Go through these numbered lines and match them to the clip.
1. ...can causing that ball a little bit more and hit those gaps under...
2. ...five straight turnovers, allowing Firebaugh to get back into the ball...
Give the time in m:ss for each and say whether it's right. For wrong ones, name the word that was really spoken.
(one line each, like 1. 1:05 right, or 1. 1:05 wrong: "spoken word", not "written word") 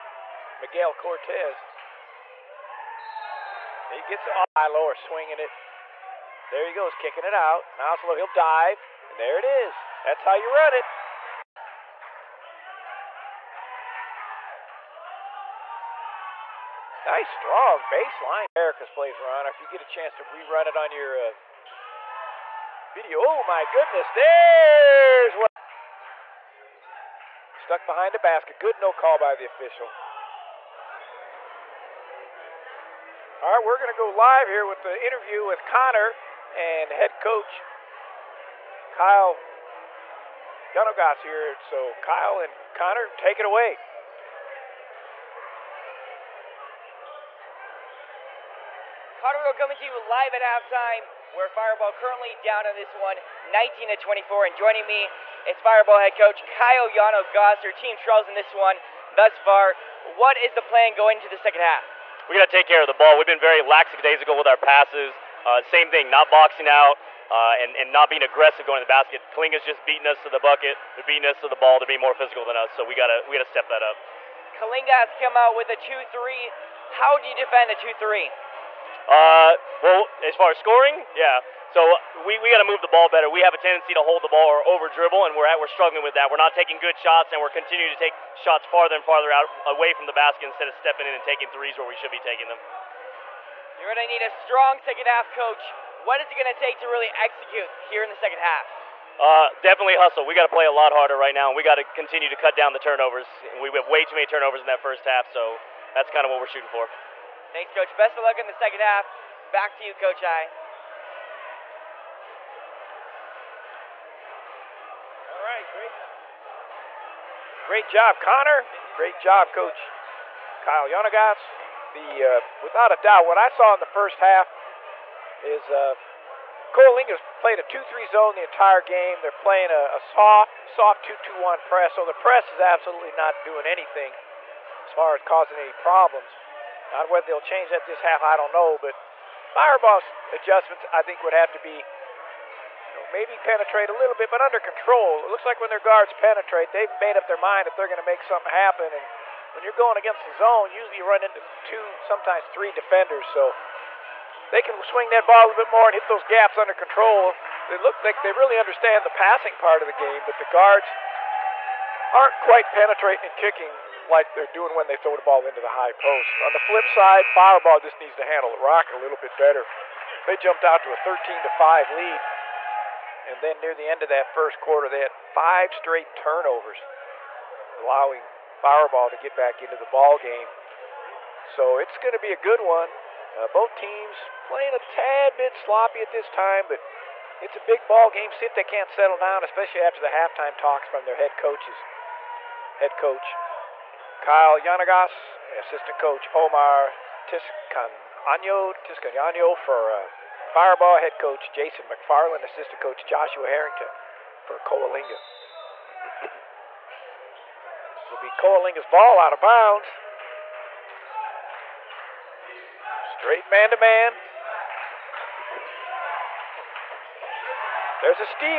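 1. 2:34 wrong: "swing", not "causing"
2. 2:55 right.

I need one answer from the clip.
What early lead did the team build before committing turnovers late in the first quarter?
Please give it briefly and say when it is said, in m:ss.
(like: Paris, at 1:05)
13 to 5, at 2:50.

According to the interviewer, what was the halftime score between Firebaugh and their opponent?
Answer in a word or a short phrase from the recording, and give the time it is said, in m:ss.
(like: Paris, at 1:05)
19 to 24, at 0:53.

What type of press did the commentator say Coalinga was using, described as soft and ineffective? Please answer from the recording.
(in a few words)
2-2-1.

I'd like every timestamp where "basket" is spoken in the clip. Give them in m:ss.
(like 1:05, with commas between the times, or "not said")
0:28, 1:08, 1:30.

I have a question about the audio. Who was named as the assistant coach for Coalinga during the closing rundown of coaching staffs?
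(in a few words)
Joshua Harrington.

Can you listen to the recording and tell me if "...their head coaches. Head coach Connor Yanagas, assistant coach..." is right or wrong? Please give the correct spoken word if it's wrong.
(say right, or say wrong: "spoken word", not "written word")
wrong: "Kyle", not "Connor".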